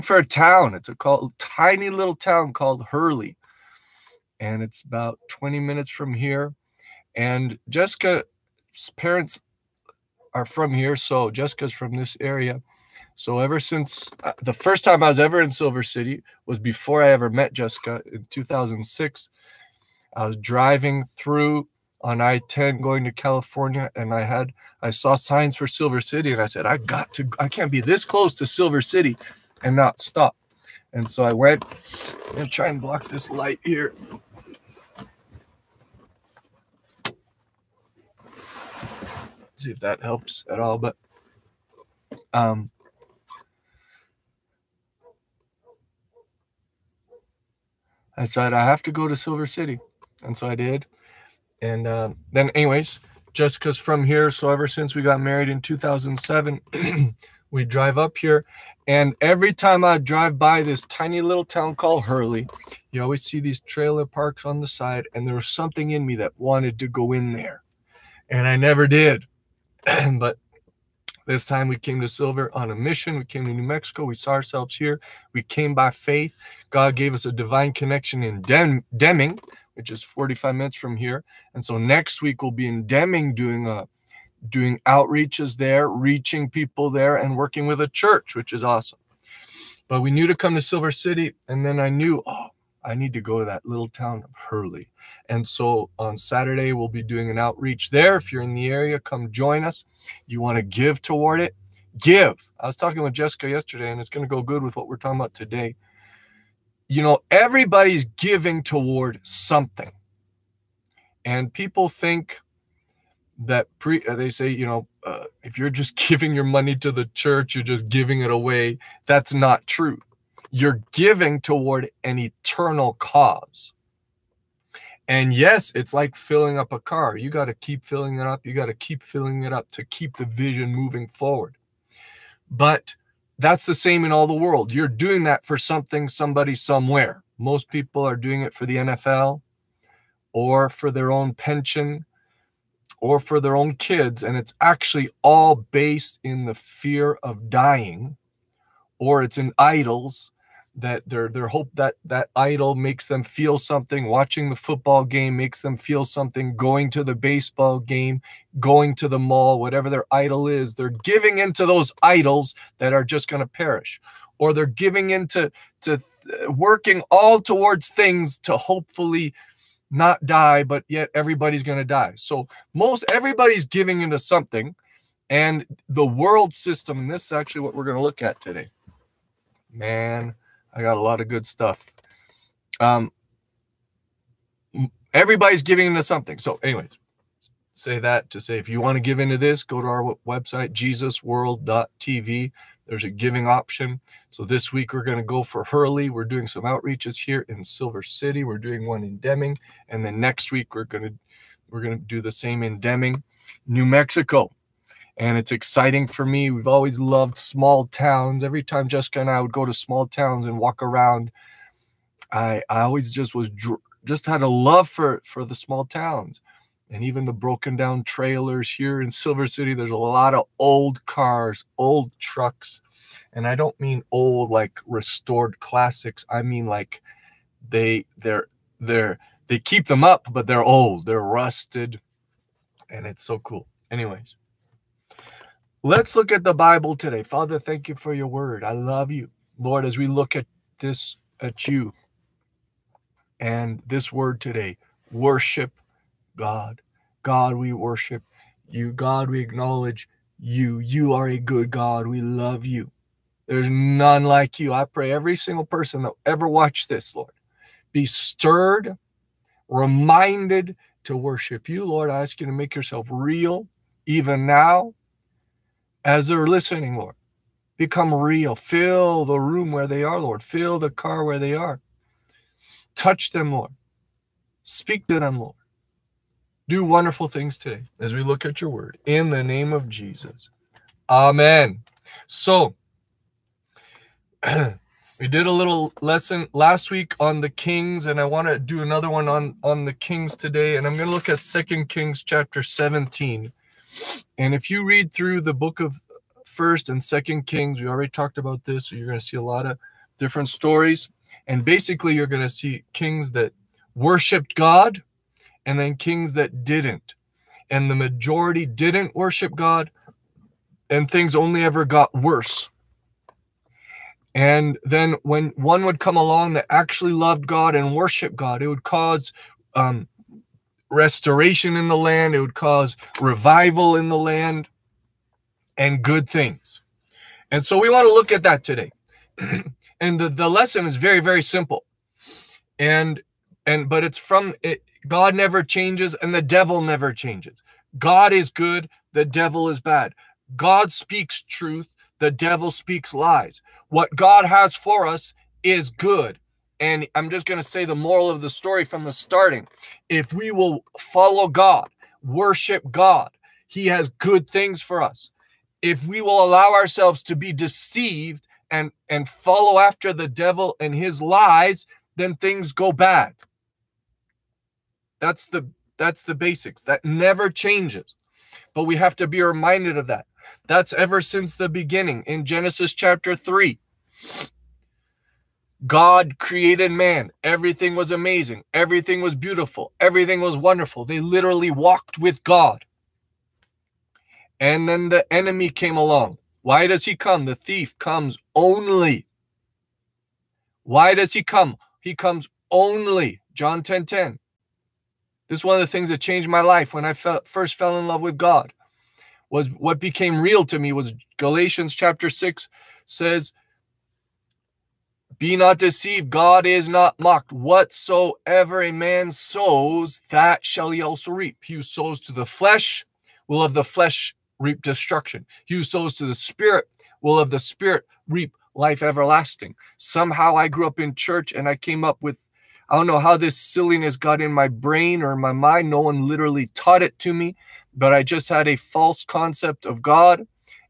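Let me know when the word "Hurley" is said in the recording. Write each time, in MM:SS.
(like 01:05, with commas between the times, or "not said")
00:02, 01:02, 01:34, 03:15.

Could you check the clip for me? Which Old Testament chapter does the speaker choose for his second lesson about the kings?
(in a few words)
2 Kings 17.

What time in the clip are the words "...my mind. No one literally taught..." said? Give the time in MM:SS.
07:05.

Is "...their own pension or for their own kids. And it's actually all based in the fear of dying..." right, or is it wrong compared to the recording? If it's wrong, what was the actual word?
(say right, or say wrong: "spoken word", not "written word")
right.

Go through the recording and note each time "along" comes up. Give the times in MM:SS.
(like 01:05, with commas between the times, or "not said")
05:16, 06:25.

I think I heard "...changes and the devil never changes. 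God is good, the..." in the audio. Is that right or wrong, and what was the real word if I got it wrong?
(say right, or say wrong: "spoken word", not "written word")
right.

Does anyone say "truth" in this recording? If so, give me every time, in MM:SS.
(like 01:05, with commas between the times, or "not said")
05:41.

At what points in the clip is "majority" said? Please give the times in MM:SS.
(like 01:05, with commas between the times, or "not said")
05:07.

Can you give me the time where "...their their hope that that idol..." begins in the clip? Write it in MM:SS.
02:31.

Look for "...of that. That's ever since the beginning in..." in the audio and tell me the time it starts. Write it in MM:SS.
06:09.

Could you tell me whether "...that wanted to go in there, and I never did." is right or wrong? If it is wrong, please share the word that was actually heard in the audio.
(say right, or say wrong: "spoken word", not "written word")
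right.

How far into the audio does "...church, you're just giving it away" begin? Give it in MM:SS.
01:57.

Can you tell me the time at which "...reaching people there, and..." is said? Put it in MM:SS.
01:25.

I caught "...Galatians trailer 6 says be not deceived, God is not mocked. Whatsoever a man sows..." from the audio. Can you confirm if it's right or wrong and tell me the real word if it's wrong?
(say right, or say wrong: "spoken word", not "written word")
wrong: "chapter", not "trailer".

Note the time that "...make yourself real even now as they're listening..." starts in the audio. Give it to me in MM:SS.
04:22.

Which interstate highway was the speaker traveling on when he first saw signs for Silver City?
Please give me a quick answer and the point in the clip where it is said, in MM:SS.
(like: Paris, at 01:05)
I-10, at 00:22.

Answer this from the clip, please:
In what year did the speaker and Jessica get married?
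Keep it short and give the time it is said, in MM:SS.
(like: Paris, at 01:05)
2007, at 00:55.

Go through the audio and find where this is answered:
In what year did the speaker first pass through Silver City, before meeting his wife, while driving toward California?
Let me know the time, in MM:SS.
00:18.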